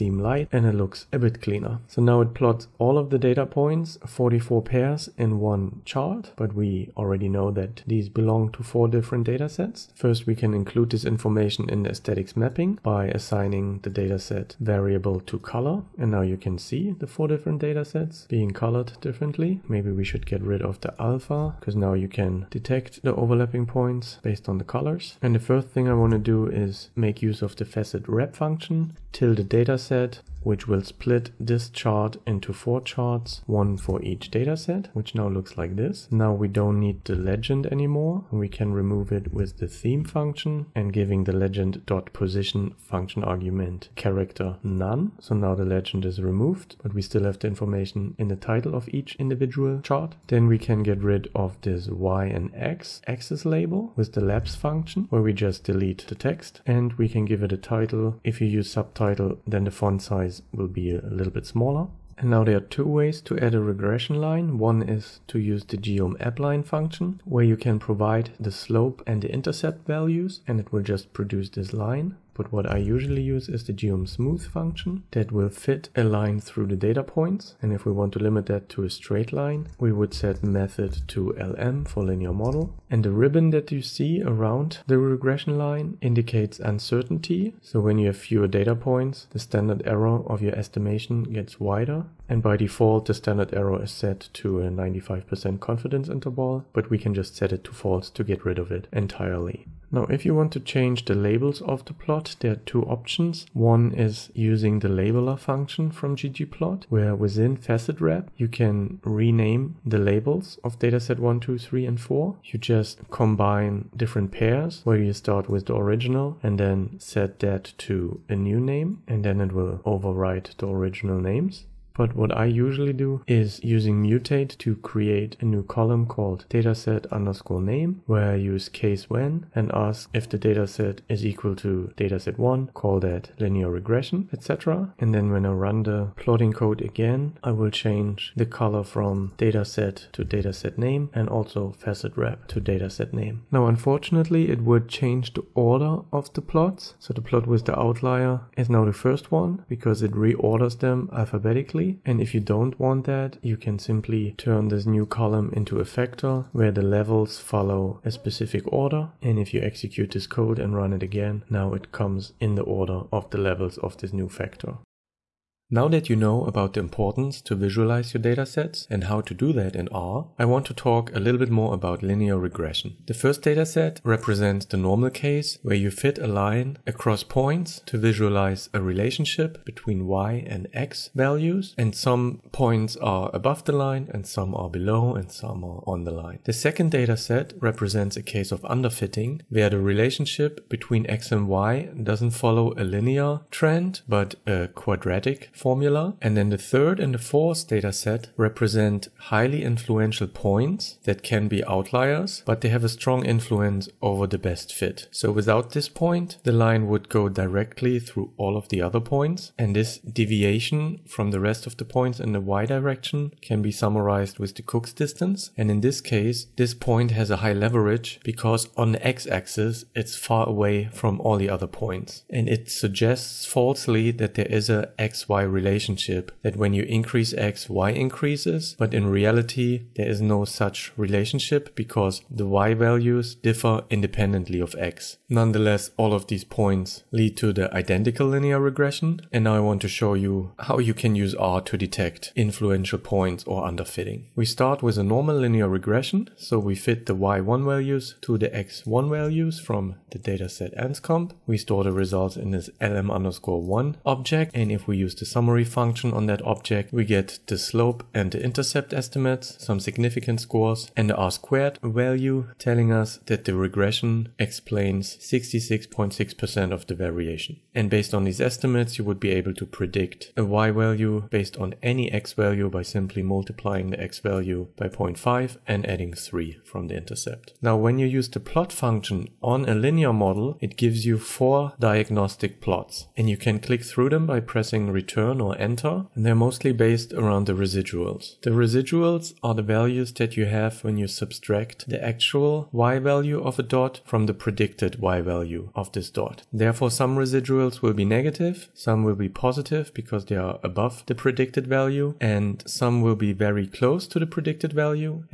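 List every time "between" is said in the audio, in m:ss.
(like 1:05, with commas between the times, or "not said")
2:59, 3:10.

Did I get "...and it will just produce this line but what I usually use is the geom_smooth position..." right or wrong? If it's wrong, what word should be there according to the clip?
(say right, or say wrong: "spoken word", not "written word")
wrong: "function", not "position".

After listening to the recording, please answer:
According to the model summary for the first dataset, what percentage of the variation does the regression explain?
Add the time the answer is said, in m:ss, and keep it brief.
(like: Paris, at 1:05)
66.6%, at 4:25.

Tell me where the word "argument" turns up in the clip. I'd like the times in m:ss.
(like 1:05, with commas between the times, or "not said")
0:43.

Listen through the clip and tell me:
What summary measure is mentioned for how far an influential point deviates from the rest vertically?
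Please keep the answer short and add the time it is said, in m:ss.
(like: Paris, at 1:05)
Cook's distance, at 3:34.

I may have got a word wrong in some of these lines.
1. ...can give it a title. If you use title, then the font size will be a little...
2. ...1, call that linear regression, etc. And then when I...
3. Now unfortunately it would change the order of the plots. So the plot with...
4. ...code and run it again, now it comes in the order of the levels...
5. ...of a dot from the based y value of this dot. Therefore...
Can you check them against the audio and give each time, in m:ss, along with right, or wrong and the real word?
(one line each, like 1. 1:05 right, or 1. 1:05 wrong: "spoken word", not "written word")
1. 0:57 wrong: "subtitle", not "title"
2. 2:12 right
3. 2:23 right
4. 2:40 right
5. 4:53 wrong: "predicted", not "based".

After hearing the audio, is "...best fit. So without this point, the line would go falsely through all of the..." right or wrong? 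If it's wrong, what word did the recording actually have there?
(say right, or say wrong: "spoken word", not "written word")
wrong: "directly", not "falsely".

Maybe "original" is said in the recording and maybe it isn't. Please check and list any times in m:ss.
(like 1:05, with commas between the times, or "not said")
1:55, 2:00.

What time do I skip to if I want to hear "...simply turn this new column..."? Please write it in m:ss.
2:33.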